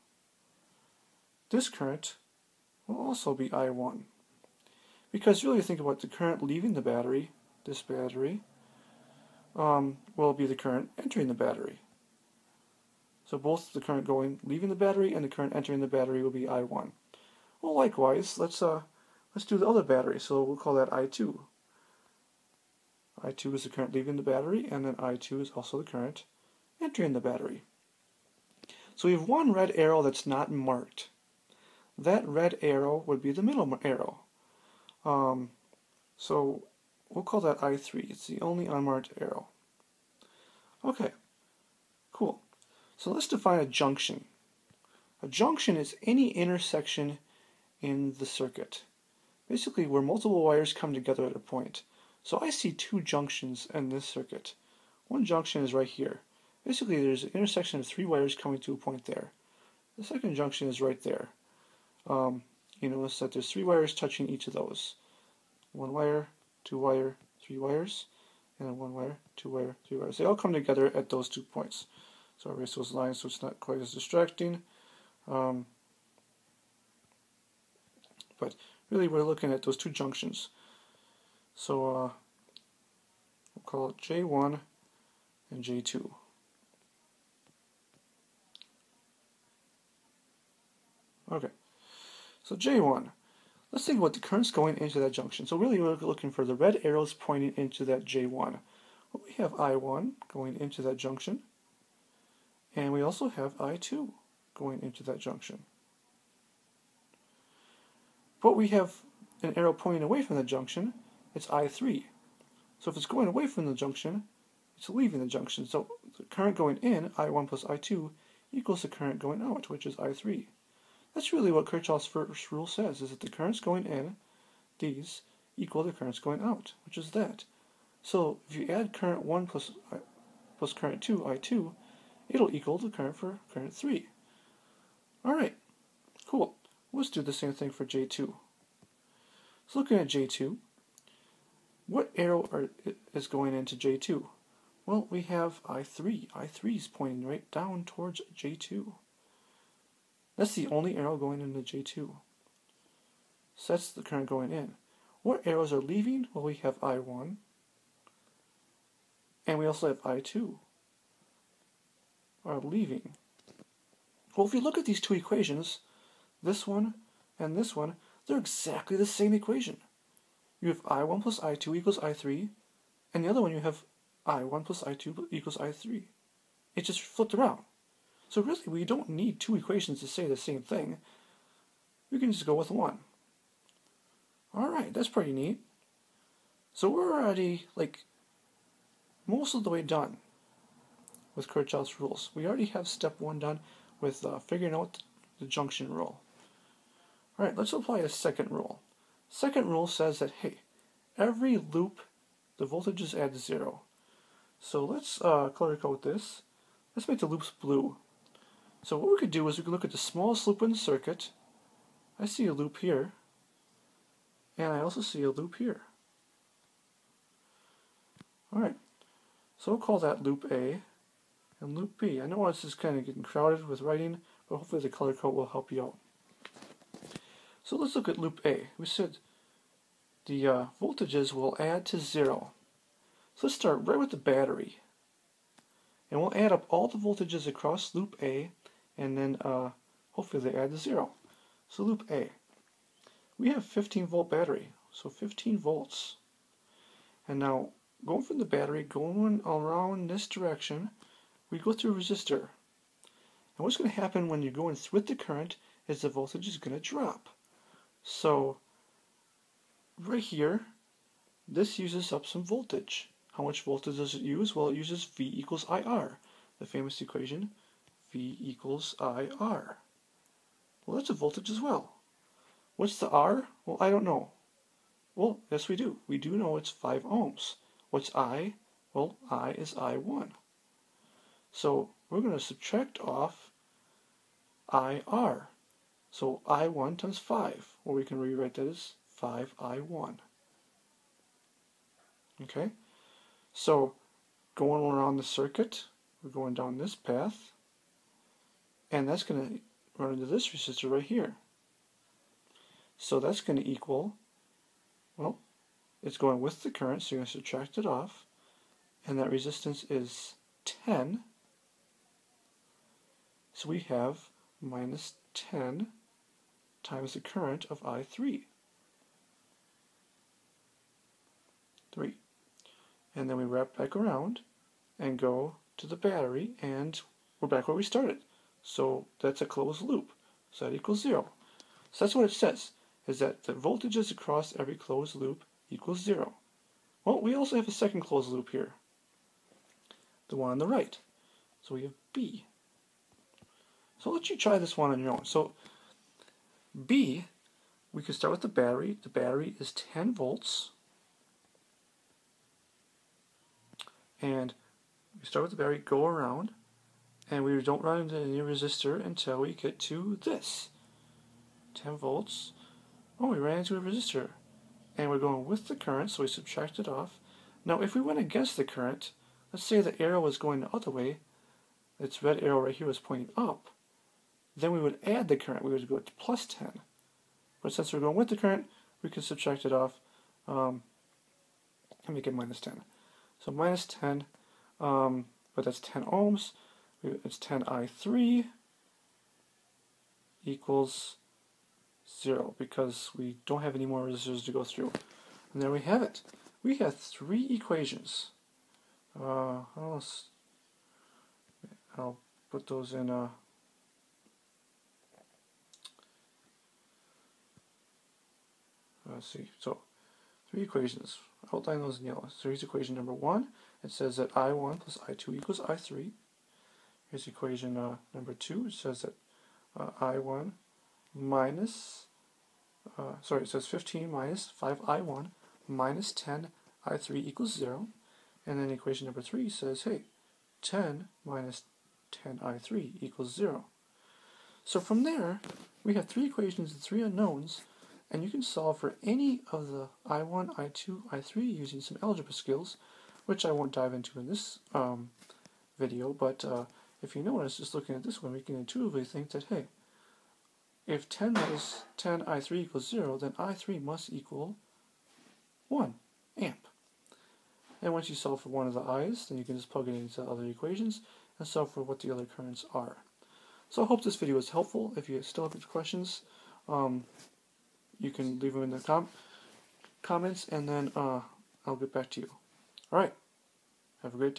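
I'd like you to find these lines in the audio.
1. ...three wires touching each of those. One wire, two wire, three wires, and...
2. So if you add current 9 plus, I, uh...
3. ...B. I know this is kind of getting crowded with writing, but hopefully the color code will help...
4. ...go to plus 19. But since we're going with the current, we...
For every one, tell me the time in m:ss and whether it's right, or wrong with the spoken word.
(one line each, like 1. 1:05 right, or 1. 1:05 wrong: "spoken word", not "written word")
1. 1:03 right
2. 2:08 wrong: "1", not "9"
3. 3:42 right
4. 6:15 wrong: "10", not "19".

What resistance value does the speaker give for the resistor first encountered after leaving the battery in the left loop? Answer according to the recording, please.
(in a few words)
5 ohms.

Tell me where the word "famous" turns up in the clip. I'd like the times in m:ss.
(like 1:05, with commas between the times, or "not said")
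4:26.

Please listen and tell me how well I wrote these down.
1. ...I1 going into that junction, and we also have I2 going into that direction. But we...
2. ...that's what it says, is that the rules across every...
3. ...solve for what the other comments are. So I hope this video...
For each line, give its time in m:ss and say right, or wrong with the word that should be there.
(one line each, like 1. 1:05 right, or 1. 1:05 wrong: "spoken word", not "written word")
1. 1:39 wrong: "junction", not "direction"
2. 5:32 wrong: "voltages", not "rules"
3. 7:41 wrong: "currents", not "comments".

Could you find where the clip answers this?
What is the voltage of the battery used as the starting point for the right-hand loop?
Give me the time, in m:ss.
5:49.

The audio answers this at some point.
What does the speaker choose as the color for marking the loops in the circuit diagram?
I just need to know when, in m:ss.
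3:26.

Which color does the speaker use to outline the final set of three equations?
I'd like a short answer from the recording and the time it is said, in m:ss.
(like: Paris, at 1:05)
yellow, at 6:51.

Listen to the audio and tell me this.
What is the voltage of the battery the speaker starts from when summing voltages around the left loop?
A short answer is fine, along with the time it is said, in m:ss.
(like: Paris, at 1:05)
15 volts, at 4:05.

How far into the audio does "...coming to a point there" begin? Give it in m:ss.
0:58.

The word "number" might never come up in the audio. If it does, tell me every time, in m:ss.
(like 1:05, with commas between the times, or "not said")
6:52, 6:58, 7:09.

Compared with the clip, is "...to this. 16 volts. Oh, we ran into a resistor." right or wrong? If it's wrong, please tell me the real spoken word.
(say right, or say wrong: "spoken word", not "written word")
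wrong: "10", not "16".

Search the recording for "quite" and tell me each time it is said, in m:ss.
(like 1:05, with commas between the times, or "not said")
1:13.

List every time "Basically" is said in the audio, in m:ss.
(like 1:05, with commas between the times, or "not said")
0:49, 0:56.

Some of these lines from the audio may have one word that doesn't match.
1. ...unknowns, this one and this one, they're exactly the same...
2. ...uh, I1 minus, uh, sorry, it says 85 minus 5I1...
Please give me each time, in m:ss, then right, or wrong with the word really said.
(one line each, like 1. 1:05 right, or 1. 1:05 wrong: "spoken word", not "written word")
1. 2:45 wrong: "equations", not "unknowns"
2. 6:59 wrong: "15", not "85".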